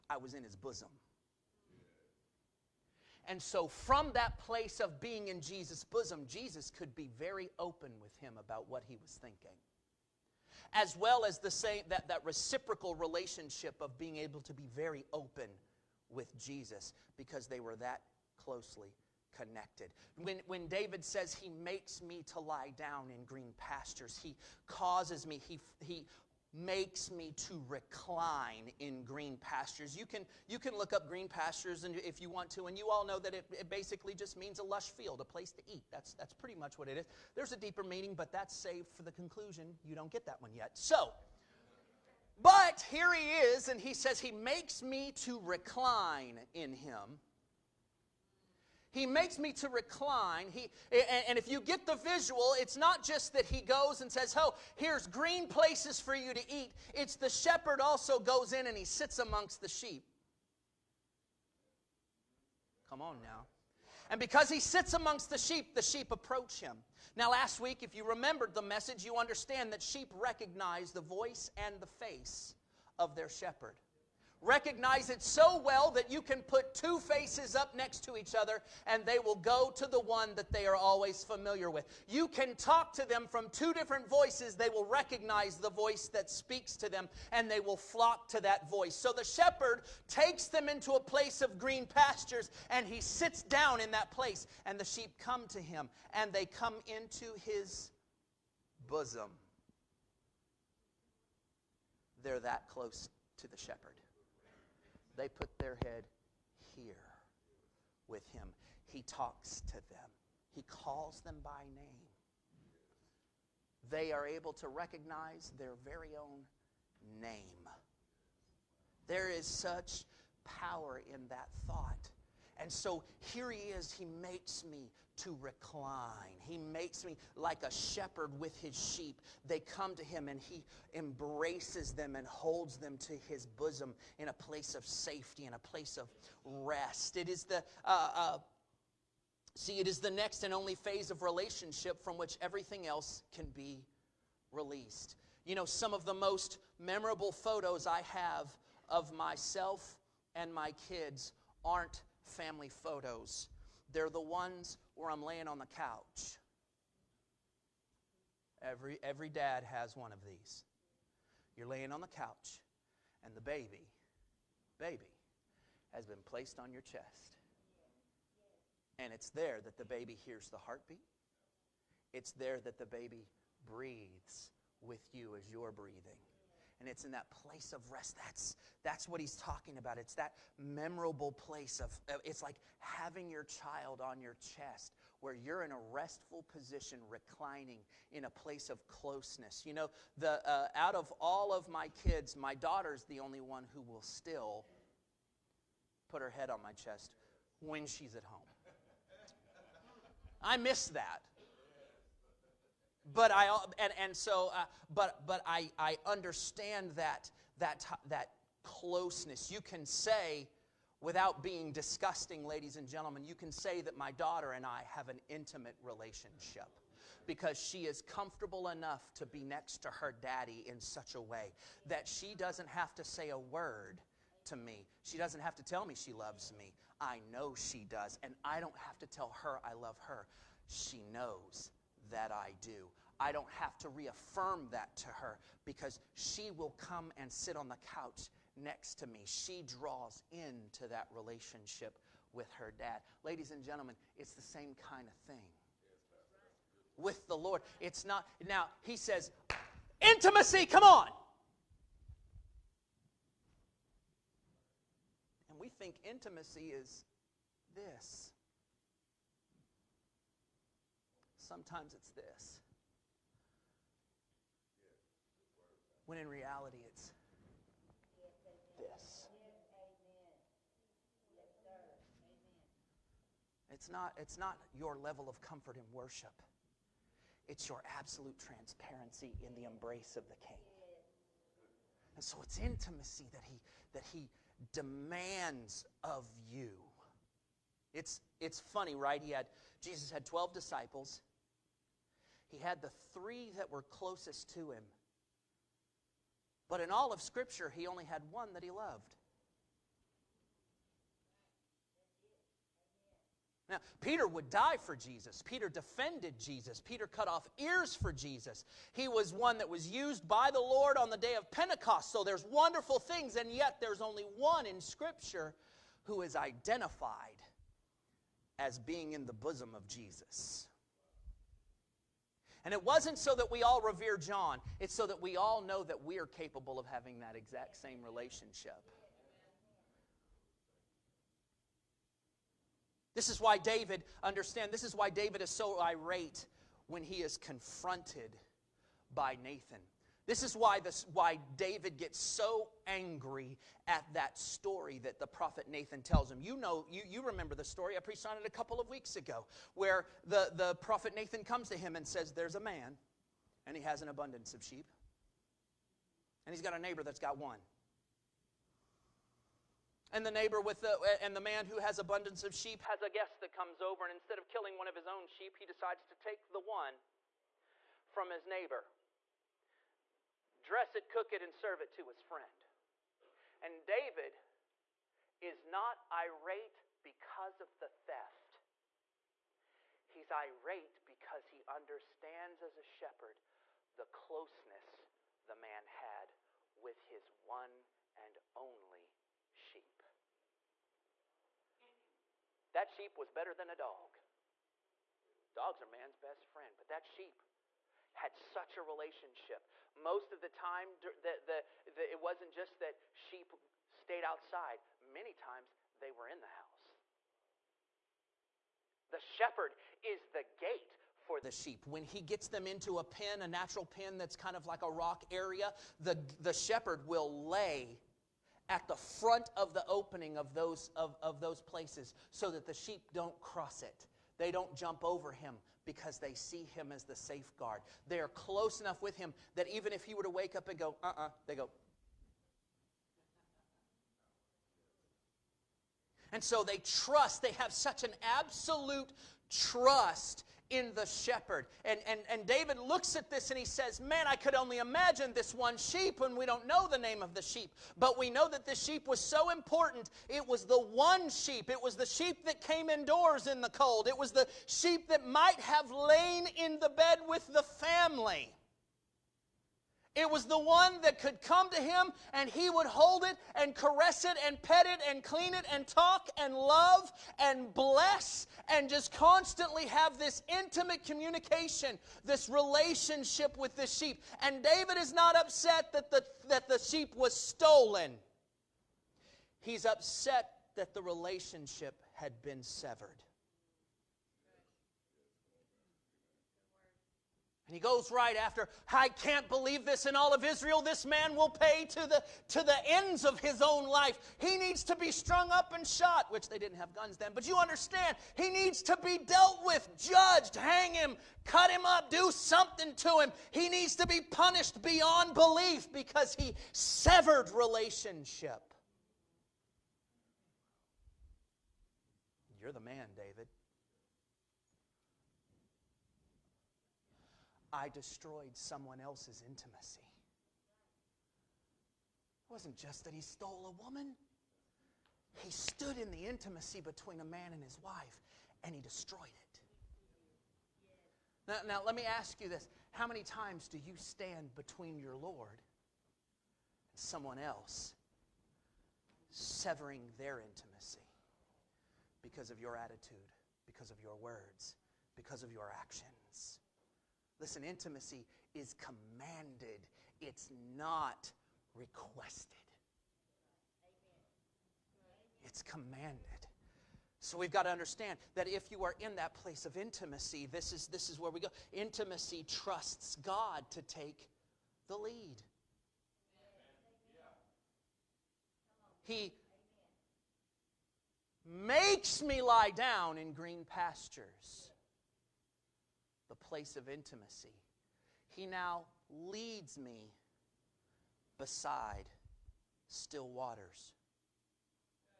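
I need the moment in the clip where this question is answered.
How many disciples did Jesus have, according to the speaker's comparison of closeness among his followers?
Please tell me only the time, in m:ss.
4:50.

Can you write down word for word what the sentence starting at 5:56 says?
And he's got a neighbor that's got one.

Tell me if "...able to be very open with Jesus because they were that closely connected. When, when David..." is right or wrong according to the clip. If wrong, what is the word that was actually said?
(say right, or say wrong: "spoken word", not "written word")
right.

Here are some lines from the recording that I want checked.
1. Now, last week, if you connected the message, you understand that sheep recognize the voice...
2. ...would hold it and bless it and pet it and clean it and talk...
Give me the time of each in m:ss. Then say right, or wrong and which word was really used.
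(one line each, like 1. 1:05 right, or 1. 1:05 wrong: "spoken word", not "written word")
1. 1:07 wrong: "remembered", not "connected"
2. 7:42 wrong: "caress", not "bless".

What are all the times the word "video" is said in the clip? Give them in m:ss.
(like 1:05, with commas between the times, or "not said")
not said.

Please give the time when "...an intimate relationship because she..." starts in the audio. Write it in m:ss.
3:35.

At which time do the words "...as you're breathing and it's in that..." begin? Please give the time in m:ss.
2:55.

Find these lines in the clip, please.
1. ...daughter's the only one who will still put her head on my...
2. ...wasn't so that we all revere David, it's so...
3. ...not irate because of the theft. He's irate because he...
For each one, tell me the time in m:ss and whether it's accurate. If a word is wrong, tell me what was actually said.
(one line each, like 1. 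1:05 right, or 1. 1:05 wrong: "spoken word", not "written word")
1. 3:12 right
2. 5:22 wrong: "John", not "David"
3. 6:15 right.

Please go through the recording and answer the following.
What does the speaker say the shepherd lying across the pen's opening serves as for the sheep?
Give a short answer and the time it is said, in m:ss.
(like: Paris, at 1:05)
the gate, at 6:49.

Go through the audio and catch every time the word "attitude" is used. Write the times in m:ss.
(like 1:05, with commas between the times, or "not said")
9:02.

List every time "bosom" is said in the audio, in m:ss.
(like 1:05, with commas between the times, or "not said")
0:00, 0:05, 1:38, 2:13, 5:19.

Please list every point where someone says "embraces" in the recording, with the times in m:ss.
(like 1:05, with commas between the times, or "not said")
2:10, 4:39.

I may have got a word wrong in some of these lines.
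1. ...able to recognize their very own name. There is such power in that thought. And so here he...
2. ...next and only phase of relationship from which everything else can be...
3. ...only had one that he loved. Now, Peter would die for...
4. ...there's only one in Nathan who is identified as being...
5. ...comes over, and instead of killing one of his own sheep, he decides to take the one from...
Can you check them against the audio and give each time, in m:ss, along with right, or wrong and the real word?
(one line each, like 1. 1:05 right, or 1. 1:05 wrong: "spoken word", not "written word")
1. 1:54 right
2. 2:20 right
3. 4:57 right
4. 5:13 wrong: "Scripture", not "Nathan"
5. 6:03 right.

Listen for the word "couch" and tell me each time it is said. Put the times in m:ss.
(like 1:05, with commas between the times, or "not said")
2:35, 2:42, 3:57.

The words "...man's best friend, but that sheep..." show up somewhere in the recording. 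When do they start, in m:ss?
6:35.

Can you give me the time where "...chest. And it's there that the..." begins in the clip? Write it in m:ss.
2:46.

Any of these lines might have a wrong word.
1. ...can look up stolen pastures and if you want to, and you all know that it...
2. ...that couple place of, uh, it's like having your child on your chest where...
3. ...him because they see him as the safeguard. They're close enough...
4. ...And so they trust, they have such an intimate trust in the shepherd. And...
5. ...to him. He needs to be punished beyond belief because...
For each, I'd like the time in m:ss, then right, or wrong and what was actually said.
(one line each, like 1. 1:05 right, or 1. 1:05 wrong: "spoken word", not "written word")
1. 0:30 wrong: "green", not "stolen"
2. 3:00 wrong: "memorable", not "couple"
3. 7:05 right
4. 7:16 wrong: "absolute", not "intimate"
5. 8:22 right.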